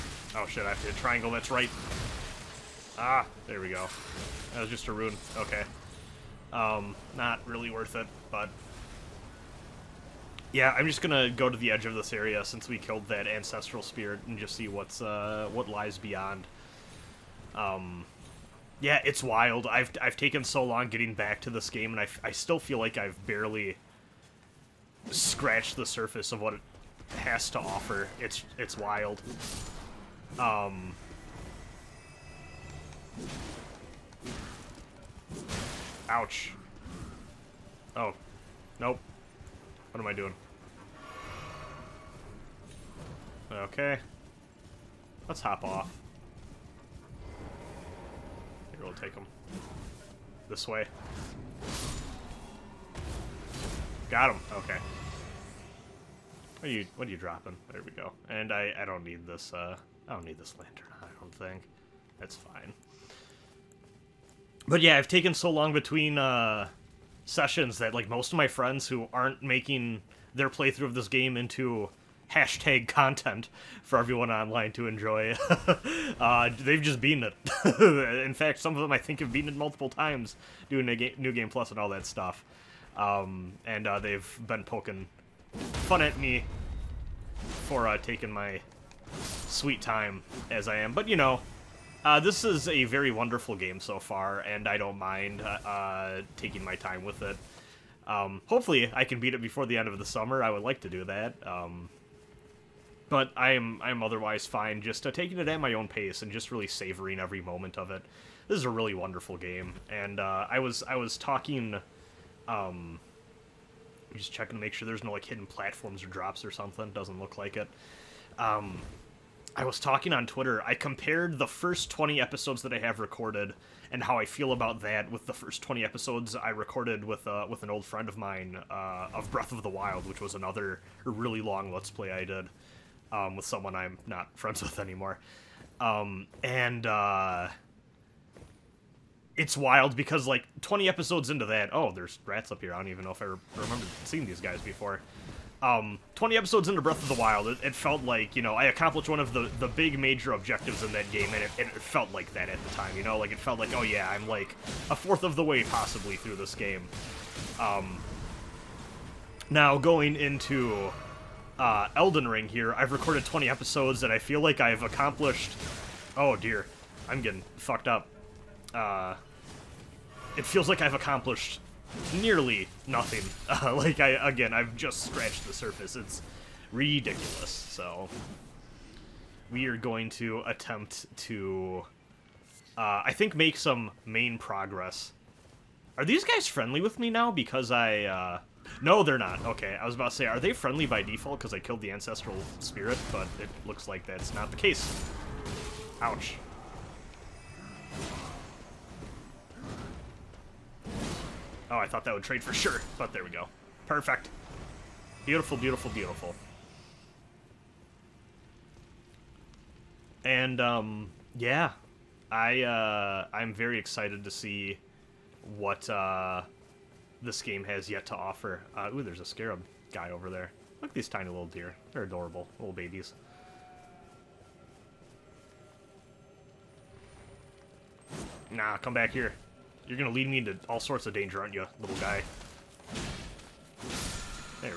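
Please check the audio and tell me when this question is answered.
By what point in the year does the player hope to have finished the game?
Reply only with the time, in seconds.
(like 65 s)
99 s.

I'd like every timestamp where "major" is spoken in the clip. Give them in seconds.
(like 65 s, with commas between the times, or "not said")
149 s.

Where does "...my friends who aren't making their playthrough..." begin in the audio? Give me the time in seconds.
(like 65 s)
68 s.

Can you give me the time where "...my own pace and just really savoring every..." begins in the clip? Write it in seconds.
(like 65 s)
105 s.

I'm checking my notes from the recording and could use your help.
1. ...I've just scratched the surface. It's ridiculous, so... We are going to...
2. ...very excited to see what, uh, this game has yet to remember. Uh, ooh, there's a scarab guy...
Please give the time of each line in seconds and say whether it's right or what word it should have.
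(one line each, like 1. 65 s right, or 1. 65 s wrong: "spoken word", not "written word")
1. 174 s right
2. 213 s wrong: "offer", not "remember".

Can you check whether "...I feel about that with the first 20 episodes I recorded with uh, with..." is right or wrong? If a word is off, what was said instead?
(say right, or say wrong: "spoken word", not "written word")
right.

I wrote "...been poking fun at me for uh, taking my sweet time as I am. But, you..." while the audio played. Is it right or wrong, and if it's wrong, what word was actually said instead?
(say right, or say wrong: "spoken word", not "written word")
right.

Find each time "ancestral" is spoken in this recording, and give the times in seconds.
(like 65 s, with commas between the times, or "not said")
13 s, 191 s.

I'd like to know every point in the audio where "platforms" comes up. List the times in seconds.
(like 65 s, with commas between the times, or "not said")
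115 s.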